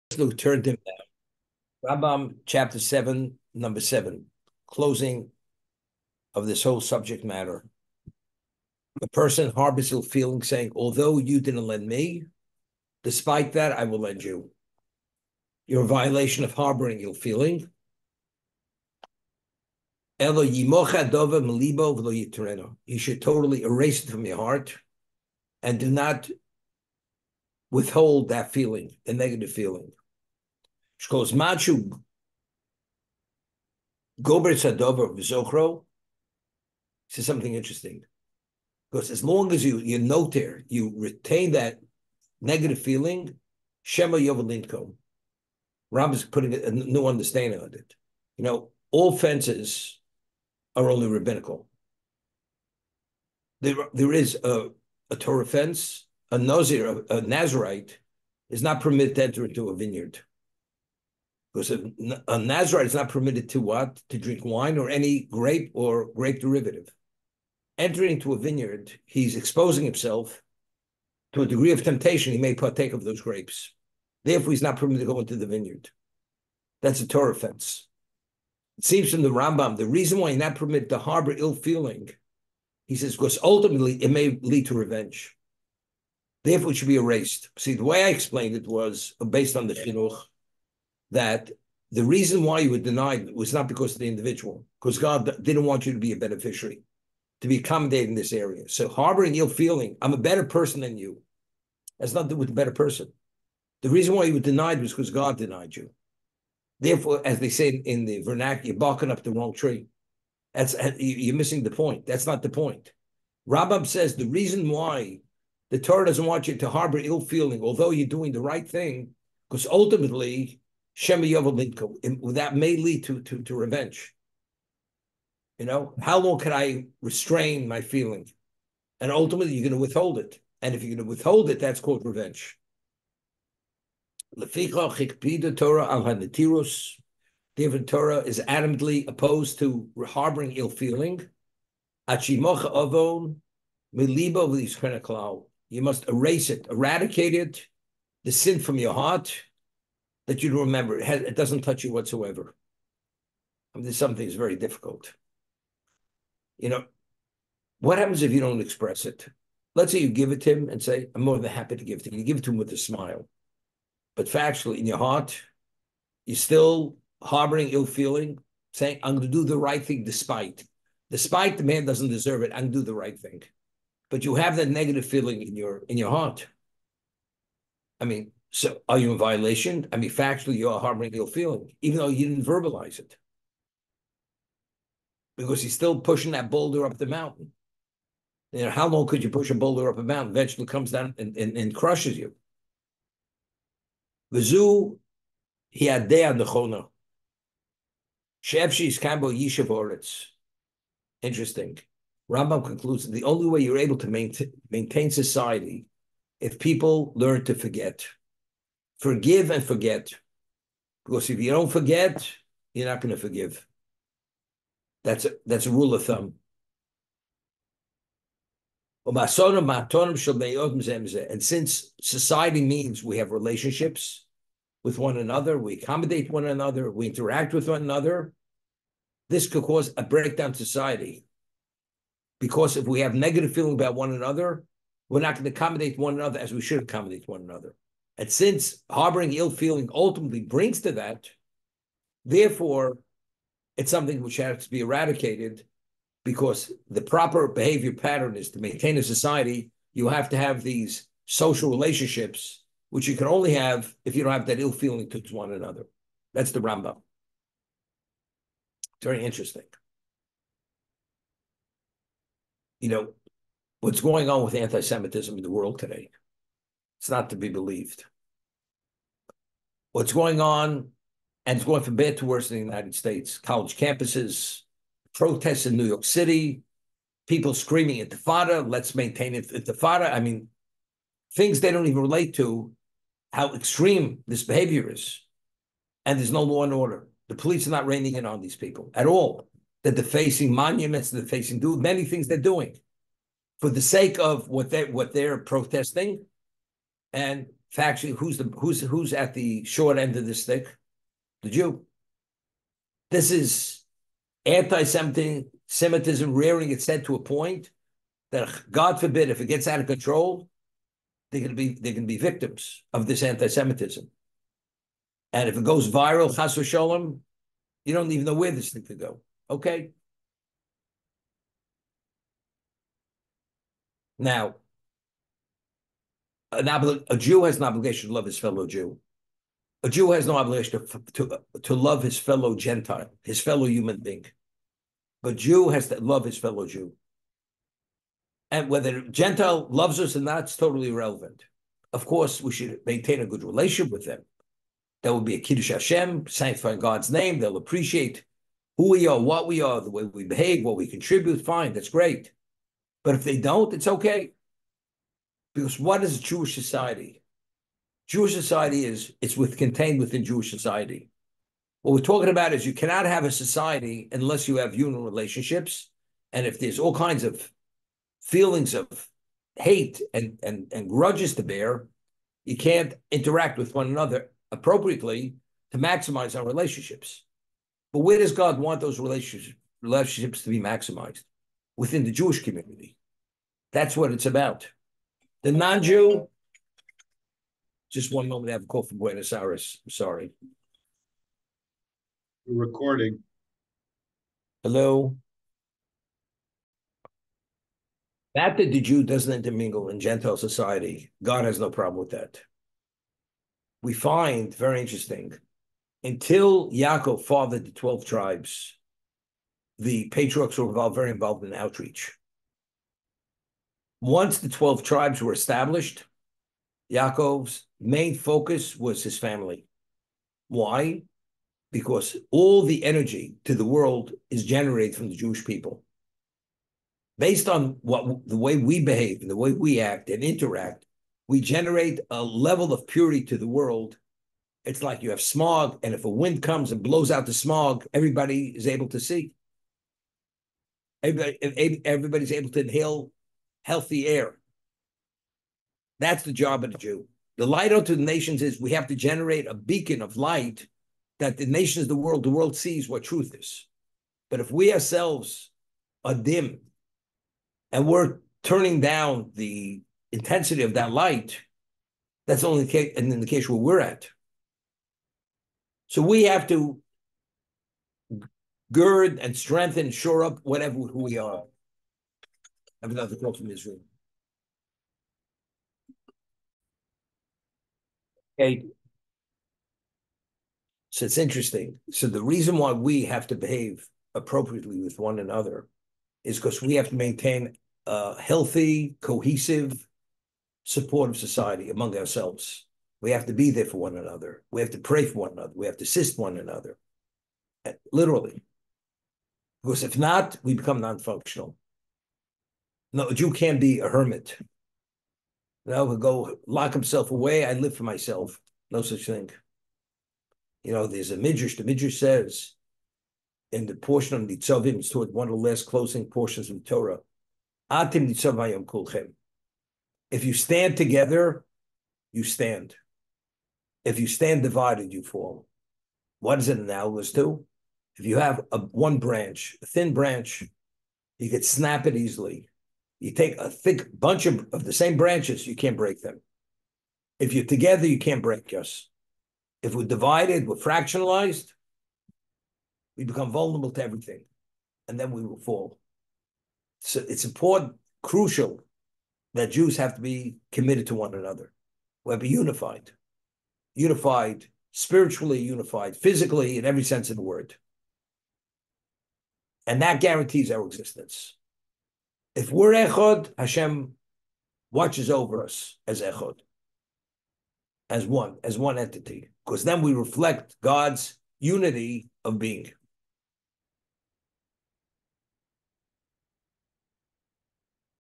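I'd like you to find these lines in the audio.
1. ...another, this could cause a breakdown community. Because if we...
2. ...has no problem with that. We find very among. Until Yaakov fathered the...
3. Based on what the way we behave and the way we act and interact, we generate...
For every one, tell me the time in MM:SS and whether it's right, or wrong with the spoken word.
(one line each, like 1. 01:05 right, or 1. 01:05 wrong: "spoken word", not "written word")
1. 03:47 wrong: "society", not "community"
2. 06:41 wrong: "interesting", not "among"
3. 07:07 right.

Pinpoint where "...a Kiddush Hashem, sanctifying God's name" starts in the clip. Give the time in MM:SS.
05:45.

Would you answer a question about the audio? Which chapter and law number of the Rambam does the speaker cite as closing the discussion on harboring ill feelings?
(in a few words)
Chapter 7, number 7.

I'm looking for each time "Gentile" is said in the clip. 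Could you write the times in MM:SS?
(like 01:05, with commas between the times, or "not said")
05:32, 05:39, 06:39.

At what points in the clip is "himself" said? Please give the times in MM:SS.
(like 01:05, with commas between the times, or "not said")
01:09, 08:26.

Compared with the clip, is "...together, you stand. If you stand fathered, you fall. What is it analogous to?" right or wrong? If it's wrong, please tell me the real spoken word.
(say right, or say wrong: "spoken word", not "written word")
wrong: "divided", not "fathered".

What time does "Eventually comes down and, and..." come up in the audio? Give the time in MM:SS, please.
03:10.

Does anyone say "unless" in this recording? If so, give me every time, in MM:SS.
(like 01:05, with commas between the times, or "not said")
06:04.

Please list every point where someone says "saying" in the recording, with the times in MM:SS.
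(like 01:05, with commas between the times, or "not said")
00:10, 02:48.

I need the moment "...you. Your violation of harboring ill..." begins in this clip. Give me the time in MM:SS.
00:14.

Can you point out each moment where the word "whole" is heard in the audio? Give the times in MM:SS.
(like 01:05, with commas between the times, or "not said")
00:06.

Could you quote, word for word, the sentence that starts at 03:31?
Because if you don't forget, you're not going to forgive.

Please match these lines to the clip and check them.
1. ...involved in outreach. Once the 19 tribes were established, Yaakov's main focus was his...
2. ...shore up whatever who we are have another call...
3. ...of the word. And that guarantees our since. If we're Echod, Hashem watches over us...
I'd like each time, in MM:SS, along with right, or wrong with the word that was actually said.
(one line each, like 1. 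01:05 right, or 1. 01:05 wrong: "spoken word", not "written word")
1. 06:51 wrong: "12", not "19"
2. 07:49 right
3. 09:17 wrong: "existence", not "since".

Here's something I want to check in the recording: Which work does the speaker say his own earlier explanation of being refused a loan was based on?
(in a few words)
The Chinuch.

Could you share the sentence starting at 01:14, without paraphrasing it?
Therefore, he's not permitted to go into the vineyard.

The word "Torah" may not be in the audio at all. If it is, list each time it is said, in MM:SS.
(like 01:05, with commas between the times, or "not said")
00:55, 01:17, 01:55, 02:14, 08:36.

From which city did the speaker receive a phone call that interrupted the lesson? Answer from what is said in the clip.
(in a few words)
Buenos Aires.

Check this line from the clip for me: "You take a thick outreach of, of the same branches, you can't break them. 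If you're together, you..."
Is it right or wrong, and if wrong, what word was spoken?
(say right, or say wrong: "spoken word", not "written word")
wrong: "bunch", not "outreach".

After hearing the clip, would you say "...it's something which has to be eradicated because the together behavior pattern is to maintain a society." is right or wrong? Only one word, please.
wrong.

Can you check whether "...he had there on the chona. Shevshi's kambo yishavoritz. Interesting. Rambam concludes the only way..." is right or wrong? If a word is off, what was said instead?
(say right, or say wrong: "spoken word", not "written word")
right.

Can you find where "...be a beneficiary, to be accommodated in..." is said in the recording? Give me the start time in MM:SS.
01:35.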